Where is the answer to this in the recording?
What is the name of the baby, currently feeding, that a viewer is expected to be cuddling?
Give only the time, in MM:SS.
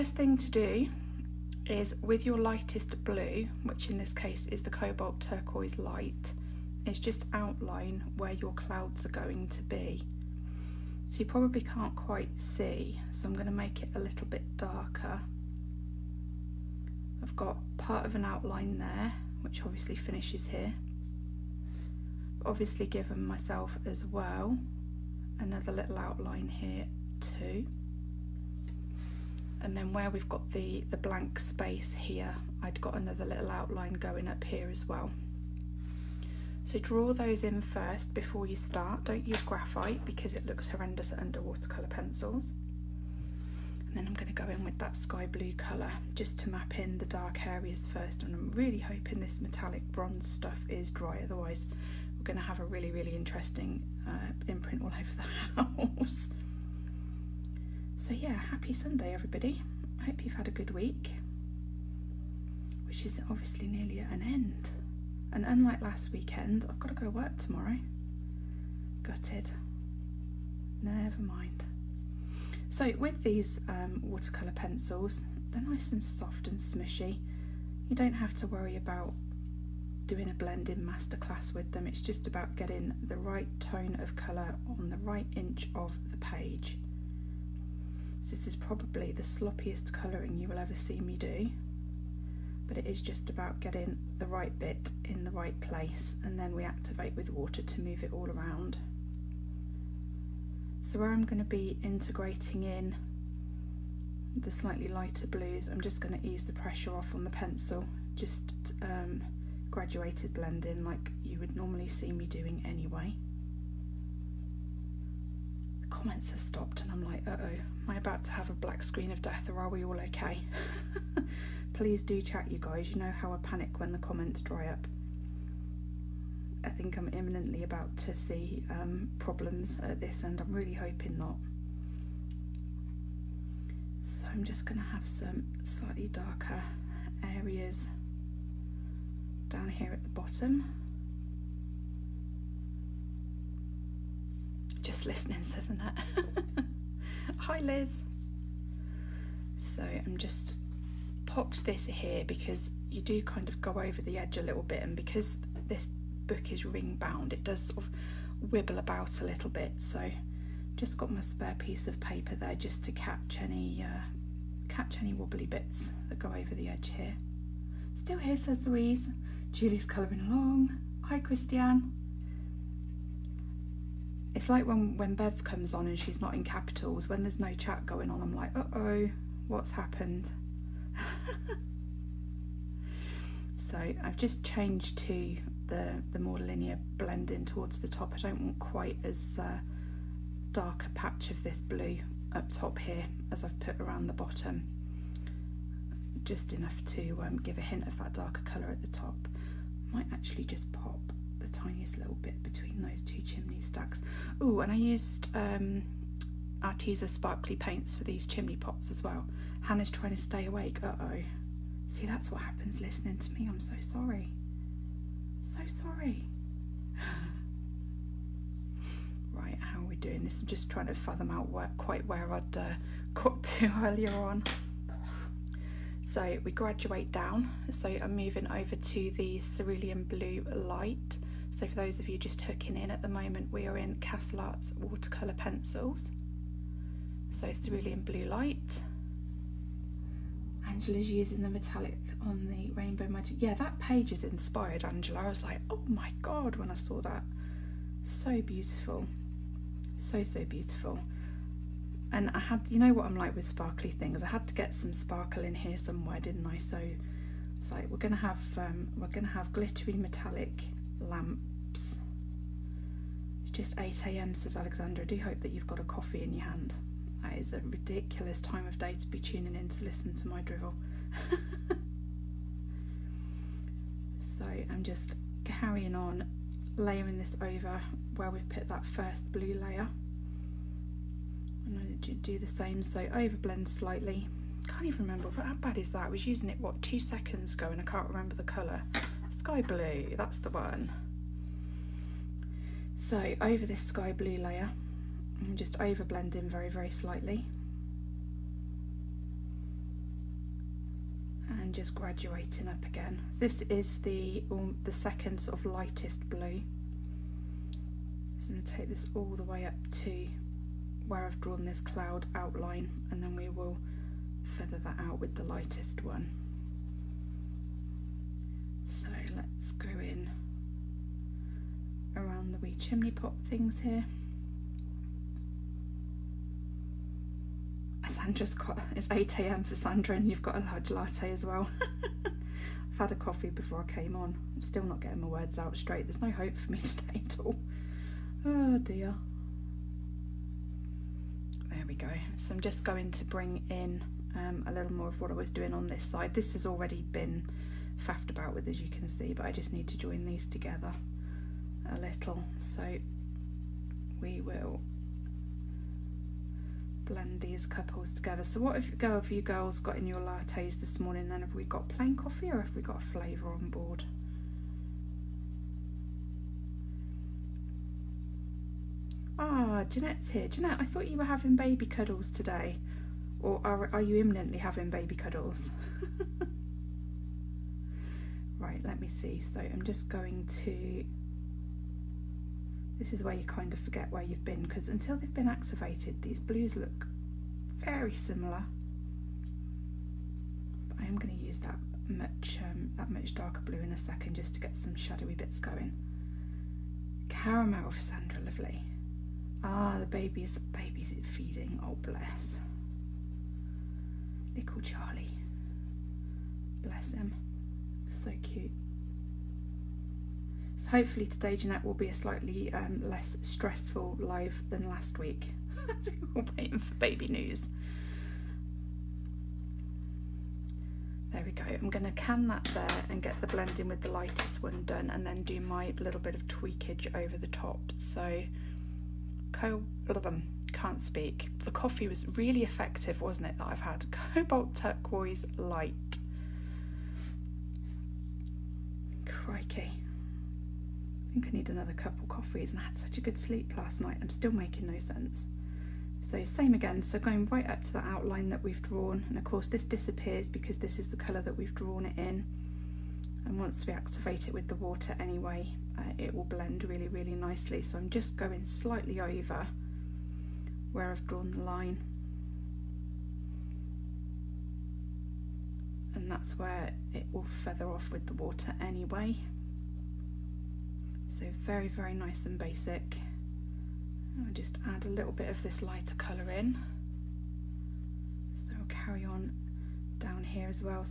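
06:44.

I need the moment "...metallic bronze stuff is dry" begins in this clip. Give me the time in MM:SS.
00:49.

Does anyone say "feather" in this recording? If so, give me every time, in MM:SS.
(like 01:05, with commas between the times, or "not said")
05:14, 07:47.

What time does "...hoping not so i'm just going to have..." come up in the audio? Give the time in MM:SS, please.
02:10.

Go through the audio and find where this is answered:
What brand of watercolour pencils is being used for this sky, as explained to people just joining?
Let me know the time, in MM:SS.
03:53.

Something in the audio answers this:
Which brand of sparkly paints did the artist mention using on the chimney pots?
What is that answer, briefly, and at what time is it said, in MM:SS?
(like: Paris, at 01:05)
Arteza, at 03:26.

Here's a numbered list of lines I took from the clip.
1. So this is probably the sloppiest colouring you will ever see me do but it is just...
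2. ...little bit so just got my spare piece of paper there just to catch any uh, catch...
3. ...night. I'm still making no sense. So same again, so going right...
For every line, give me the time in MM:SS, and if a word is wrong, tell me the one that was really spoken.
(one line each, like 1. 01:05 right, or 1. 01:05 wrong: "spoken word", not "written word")
1. 01:28 right
2. 02:39 right
3. 07:23 right.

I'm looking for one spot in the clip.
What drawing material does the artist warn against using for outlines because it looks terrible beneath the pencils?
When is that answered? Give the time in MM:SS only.
00:39.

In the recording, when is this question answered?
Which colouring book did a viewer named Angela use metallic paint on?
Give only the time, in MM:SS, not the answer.
04:02.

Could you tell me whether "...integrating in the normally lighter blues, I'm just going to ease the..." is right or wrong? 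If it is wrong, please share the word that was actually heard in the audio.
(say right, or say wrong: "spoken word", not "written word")
wrong: "slightly", not "normally".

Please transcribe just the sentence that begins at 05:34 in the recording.
I'm still not getting my words out straight.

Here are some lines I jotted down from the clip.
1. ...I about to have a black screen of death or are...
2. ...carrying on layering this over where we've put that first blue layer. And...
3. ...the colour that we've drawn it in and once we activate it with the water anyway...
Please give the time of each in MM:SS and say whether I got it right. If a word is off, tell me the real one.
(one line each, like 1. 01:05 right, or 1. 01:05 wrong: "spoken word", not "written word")
1. 01:57 right
2. 04:35 right
3. 07:31 right.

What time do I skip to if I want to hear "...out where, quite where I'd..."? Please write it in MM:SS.
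03:41.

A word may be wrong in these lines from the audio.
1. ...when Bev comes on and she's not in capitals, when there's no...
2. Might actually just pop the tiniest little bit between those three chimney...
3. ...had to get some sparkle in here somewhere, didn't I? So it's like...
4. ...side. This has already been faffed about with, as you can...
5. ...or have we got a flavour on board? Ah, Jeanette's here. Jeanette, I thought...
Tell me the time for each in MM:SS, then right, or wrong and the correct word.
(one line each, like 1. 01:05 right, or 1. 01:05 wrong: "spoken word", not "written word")
1. 02:54 right
2. 03:19 wrong: "two", not "three"
3. 04:14 right
4. 05:46 right
5. 06:02 right.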